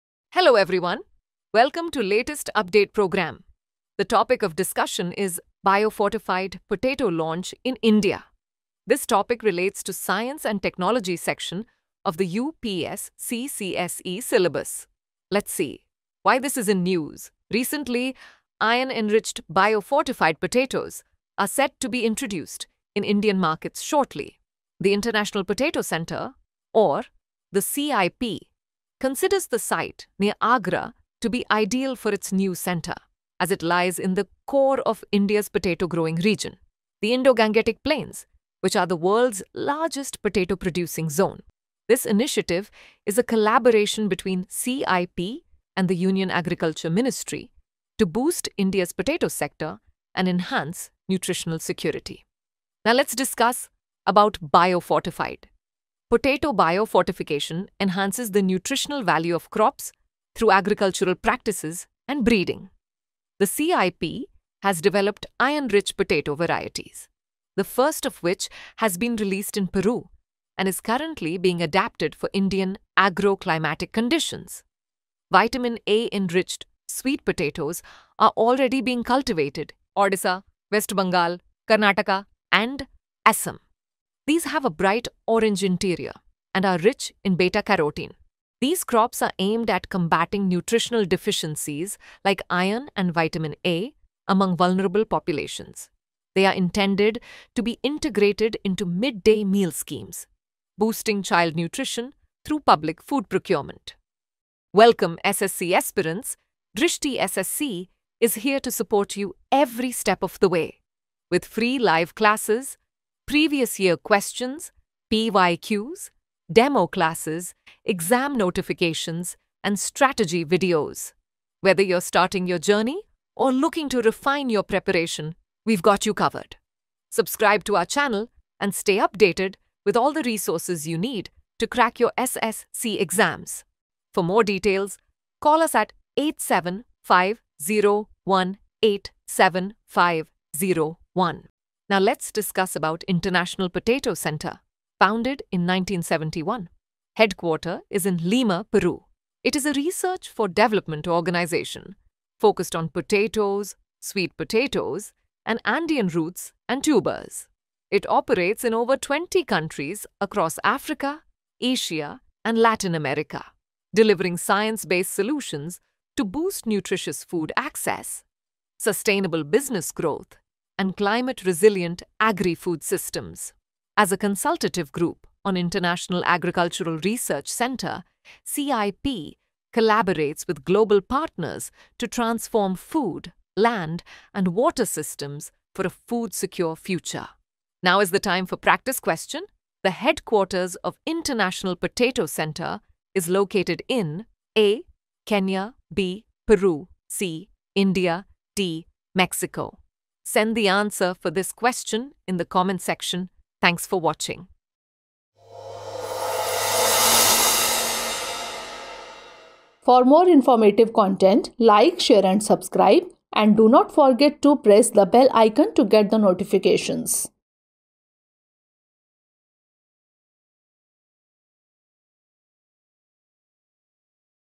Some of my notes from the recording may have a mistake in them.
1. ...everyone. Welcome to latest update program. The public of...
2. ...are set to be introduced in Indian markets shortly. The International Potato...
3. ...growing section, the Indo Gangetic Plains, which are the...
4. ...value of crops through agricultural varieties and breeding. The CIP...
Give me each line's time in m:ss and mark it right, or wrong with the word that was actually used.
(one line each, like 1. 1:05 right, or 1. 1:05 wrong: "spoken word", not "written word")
1. 0:00 wrong: "topic", not "public"
2. 0:21 right
3. 0:35 wrong: "region", not "section"
4. 0:59 wrong: "practices", not "varieties".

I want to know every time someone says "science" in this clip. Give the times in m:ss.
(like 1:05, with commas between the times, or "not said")
0:09, 2:44.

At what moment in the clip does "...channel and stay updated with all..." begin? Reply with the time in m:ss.
2:07.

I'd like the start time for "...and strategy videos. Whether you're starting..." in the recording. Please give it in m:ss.
1:59.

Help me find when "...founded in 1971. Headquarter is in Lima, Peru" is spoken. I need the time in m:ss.
2:24.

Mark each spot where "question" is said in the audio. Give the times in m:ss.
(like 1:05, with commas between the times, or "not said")
1:53, 3:08, 3:21.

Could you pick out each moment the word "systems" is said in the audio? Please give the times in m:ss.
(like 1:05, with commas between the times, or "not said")
2:52, 3:04.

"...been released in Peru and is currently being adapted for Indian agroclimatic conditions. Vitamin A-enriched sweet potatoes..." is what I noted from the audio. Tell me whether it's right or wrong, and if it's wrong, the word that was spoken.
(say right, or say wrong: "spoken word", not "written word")
right.